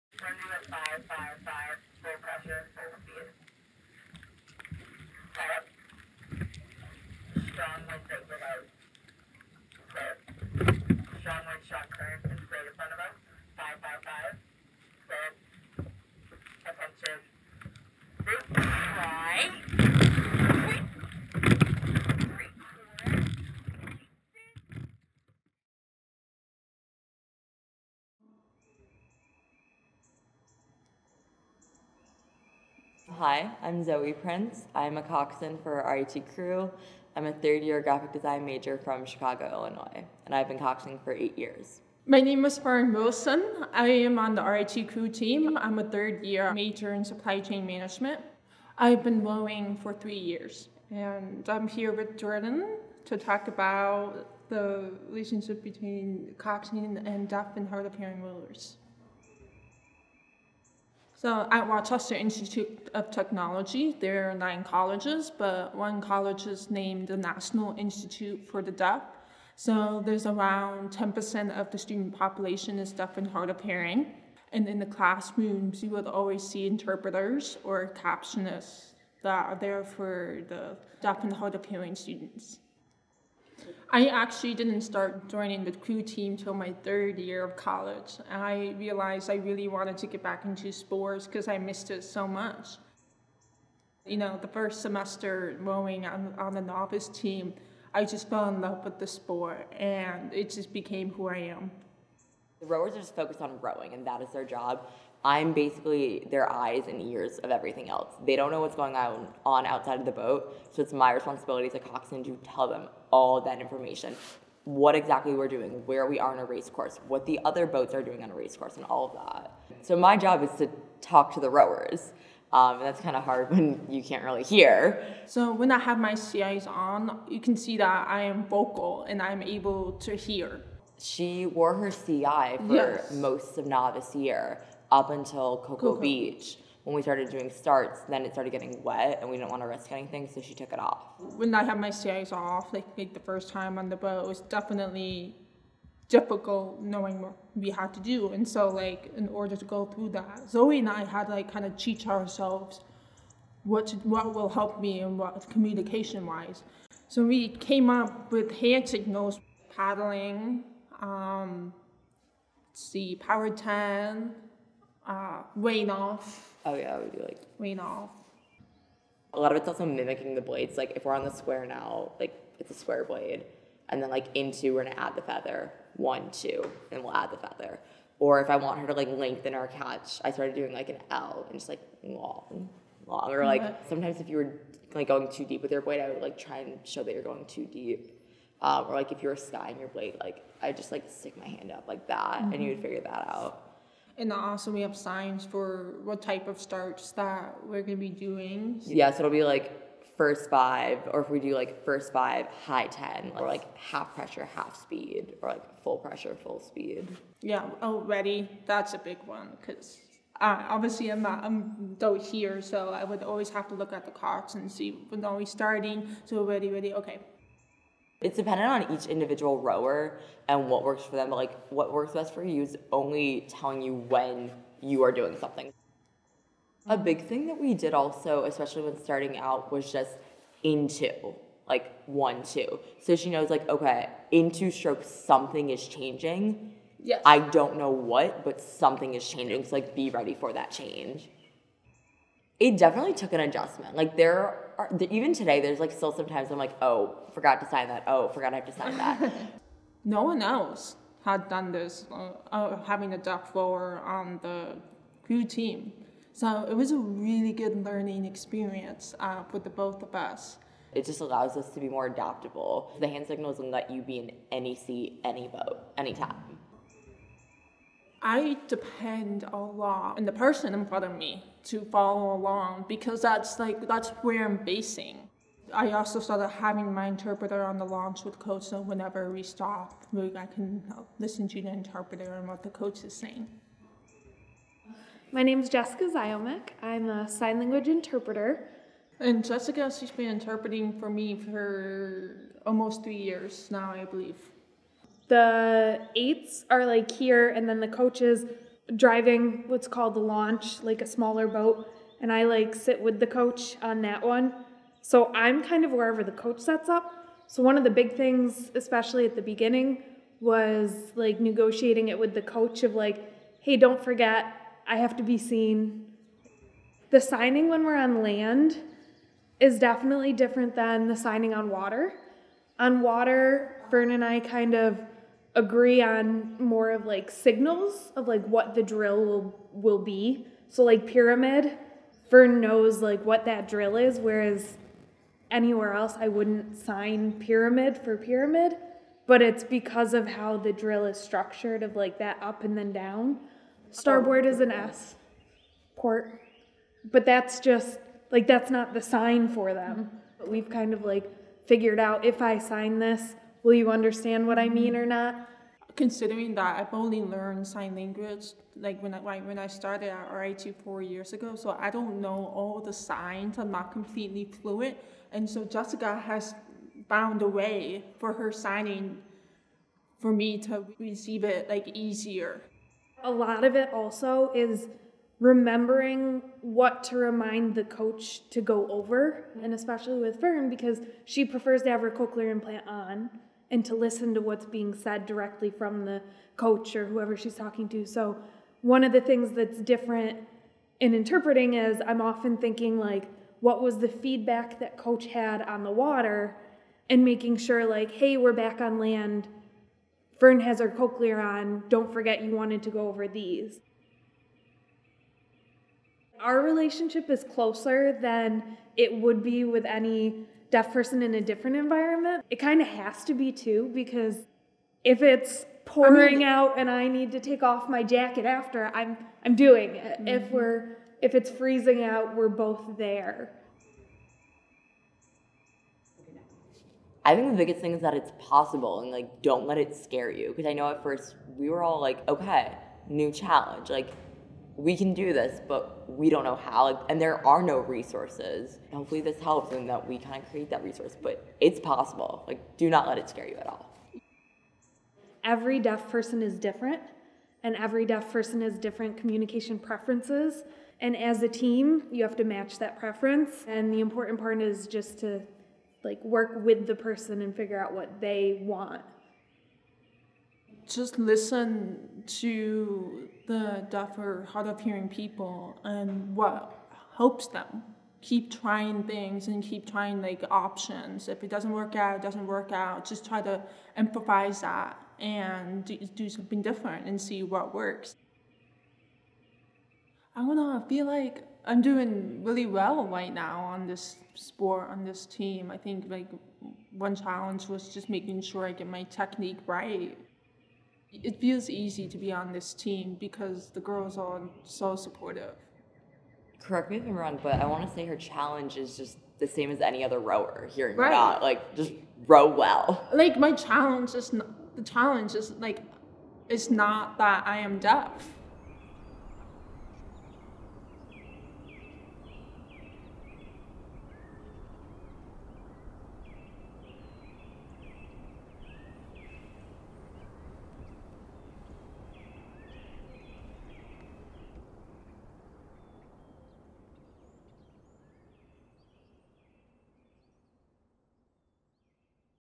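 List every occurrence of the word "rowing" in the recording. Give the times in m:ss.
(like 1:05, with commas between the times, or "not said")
0:49, 1:35, 1:43.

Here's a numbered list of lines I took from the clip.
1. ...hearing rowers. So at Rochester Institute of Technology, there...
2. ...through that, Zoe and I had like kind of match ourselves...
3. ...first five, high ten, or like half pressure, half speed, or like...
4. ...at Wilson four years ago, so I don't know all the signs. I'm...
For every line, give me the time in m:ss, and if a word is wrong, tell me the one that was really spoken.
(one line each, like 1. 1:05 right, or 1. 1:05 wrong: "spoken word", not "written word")
1. 0:57 right
2. 2:29 wrong: "teach", not "match"
3. 3:21 right
4. 6:00 wrong: "RIT", not "Wilson".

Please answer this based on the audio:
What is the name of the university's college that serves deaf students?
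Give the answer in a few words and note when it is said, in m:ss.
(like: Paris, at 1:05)
National Institute for the Deaf, at 1:07.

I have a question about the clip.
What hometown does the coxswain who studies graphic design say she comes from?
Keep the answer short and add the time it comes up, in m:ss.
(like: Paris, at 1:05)
Chicago, Illinois, at 0:39.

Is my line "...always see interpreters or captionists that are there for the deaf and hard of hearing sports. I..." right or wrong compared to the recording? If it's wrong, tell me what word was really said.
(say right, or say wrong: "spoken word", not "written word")
wrong: "students", not "sports".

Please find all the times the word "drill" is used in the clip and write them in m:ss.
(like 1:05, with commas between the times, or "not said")
5:28, 5:33, 5:40.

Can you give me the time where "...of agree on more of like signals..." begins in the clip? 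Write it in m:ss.
5:24.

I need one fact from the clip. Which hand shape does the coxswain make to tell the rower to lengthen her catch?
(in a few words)
An L.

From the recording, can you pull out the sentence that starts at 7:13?
Like we can do this, but we don't know how.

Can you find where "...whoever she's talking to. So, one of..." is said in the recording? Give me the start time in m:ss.
6:27.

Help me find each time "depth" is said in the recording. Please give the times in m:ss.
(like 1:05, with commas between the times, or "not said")
4:13.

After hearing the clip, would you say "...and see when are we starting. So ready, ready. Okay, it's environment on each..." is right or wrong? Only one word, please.
wrong.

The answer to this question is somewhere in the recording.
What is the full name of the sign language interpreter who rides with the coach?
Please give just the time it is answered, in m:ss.
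4:45.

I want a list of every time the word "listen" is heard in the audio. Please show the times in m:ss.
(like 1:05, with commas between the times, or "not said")
4:41, 6:23, 7:41.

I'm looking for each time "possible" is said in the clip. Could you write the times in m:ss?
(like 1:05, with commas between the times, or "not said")
7:08, 7:21.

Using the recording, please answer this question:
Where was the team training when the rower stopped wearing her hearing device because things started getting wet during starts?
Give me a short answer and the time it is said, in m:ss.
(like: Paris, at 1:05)
Cocoa Beach, at 2:15.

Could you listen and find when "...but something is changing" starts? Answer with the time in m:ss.
3:58.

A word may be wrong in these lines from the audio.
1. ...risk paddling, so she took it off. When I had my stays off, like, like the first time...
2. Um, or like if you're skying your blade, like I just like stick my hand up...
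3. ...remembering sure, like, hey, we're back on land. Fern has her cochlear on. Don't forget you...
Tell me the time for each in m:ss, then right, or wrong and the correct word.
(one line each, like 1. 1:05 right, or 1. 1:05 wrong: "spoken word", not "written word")
1. 2:19 wrong: "anything", not "paddling"
2. 3:08 right
3. 6:37 wrong: "making", not "remembering".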